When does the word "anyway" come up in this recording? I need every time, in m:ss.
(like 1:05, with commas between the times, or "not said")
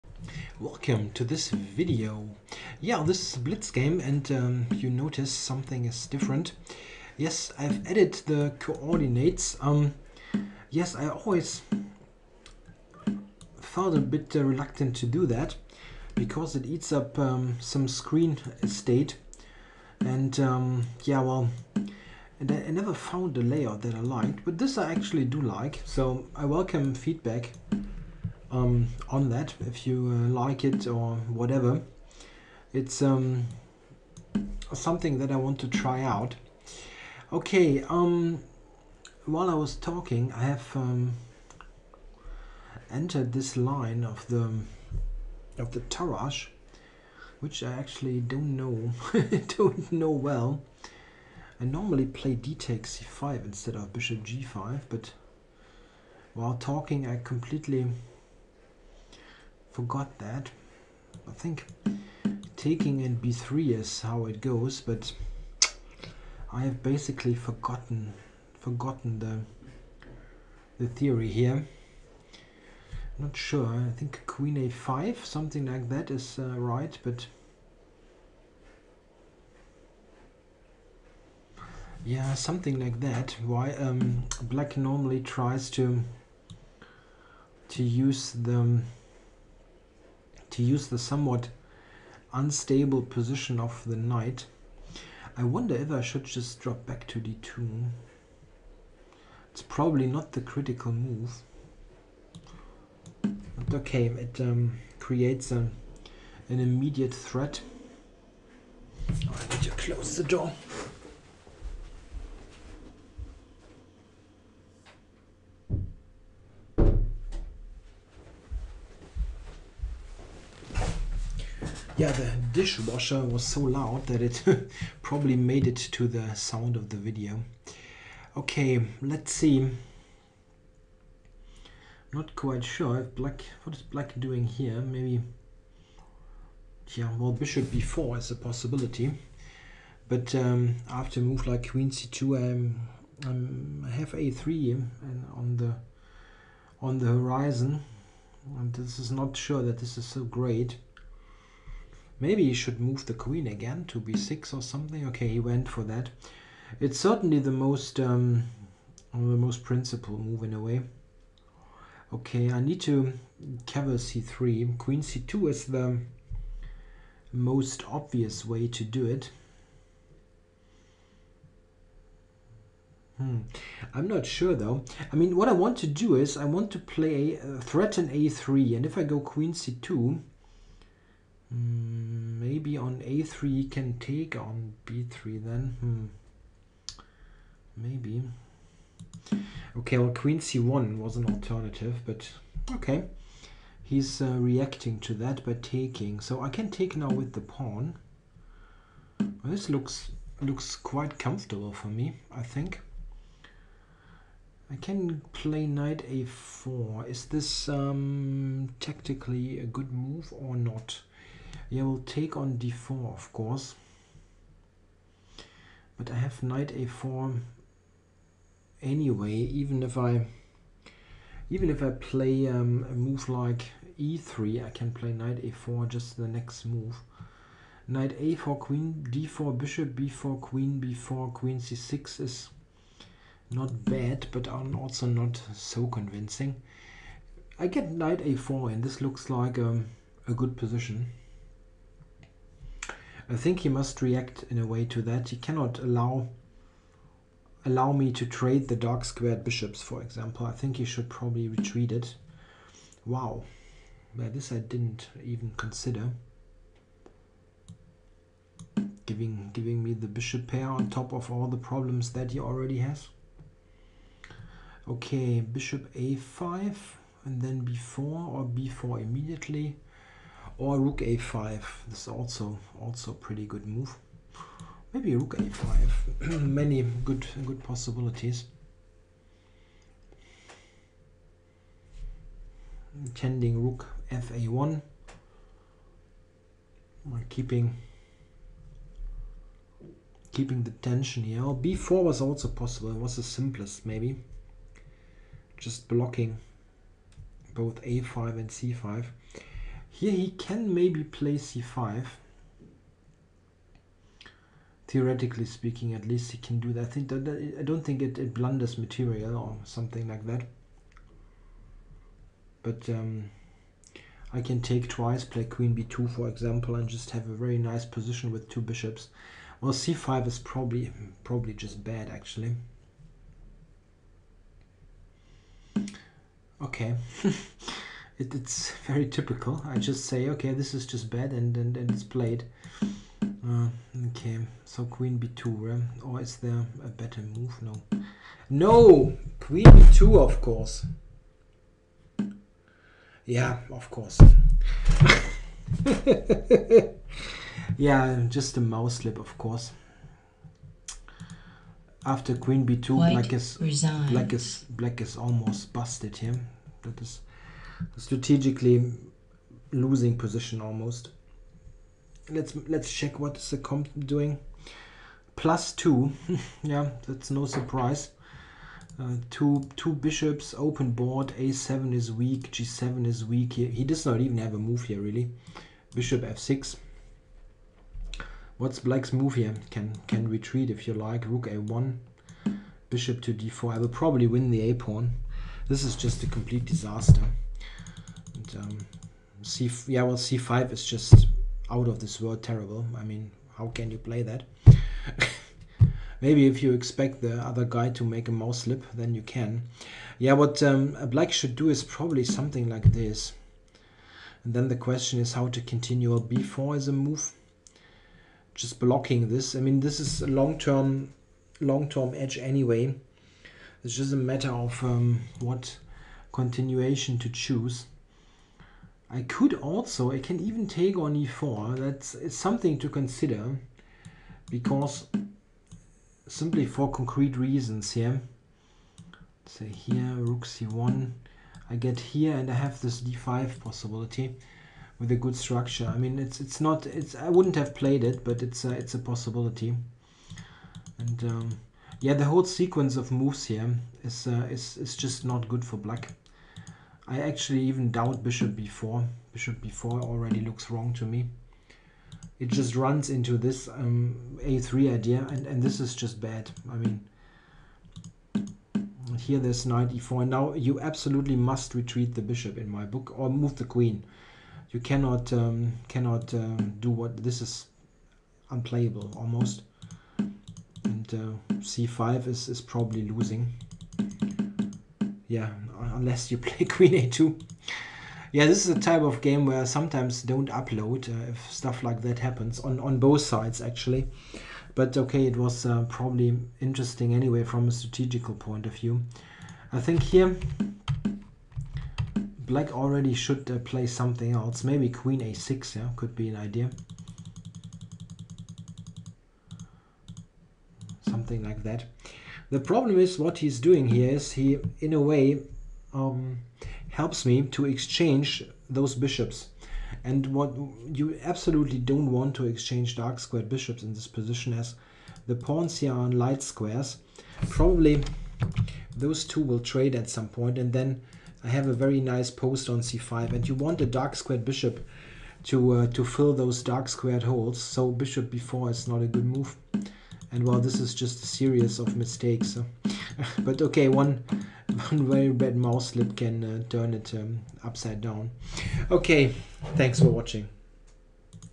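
3:38, 6:52, 8:07.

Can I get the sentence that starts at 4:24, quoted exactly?
Okay, bishop a5 and then b4 or b4 immediately.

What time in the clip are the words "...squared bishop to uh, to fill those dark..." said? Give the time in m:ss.
8:44.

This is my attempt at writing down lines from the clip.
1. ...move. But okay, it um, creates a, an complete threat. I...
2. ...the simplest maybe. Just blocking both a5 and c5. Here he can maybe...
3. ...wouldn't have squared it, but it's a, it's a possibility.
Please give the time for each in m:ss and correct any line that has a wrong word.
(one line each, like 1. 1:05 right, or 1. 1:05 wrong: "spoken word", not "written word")
1. 1:40 wrong: "immediate", not "complete"
2. 4:53 right
3. 7:17 wrong: "played", not "squared".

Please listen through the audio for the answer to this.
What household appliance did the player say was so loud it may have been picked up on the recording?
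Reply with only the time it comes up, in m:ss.
2:02.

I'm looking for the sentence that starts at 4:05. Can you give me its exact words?
He cannot allow allow me to trade the dark squared bishops, for example.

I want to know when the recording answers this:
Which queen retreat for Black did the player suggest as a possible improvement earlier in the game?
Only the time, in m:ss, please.
8:14.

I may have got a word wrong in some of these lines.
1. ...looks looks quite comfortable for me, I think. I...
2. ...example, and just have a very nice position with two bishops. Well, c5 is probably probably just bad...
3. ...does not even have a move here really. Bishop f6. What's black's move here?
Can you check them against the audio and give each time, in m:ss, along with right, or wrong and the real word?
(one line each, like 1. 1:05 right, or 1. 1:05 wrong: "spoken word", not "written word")
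1. 3:19 right
2. 5:16 right
3. 6:13 right.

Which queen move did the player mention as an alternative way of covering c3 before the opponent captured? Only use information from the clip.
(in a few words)
Queen c1.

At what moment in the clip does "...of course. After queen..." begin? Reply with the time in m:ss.
5:49.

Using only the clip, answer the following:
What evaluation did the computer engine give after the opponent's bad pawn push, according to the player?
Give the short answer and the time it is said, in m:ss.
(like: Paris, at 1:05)
Plus 2, at 6:05.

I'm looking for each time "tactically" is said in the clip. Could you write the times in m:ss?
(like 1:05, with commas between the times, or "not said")
3:28.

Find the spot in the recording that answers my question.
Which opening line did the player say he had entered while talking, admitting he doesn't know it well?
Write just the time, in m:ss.
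0:45.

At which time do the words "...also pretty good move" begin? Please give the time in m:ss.
4:32.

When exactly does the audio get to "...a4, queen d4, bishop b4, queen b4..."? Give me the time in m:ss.
3:48.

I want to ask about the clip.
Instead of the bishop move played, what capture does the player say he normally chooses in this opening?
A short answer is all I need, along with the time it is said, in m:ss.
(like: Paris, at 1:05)
d takes c5, at 0:52.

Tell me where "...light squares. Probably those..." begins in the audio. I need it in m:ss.
8:36.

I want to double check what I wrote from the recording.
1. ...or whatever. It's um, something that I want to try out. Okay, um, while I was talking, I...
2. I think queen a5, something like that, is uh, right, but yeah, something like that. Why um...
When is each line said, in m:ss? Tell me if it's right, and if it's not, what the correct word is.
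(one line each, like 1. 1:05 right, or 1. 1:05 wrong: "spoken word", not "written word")
1. 0:30 right
2. 1:13 right.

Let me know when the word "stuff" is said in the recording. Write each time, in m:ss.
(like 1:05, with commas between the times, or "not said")
8:01.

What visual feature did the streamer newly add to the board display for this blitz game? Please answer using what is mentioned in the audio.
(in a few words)
Coordinates.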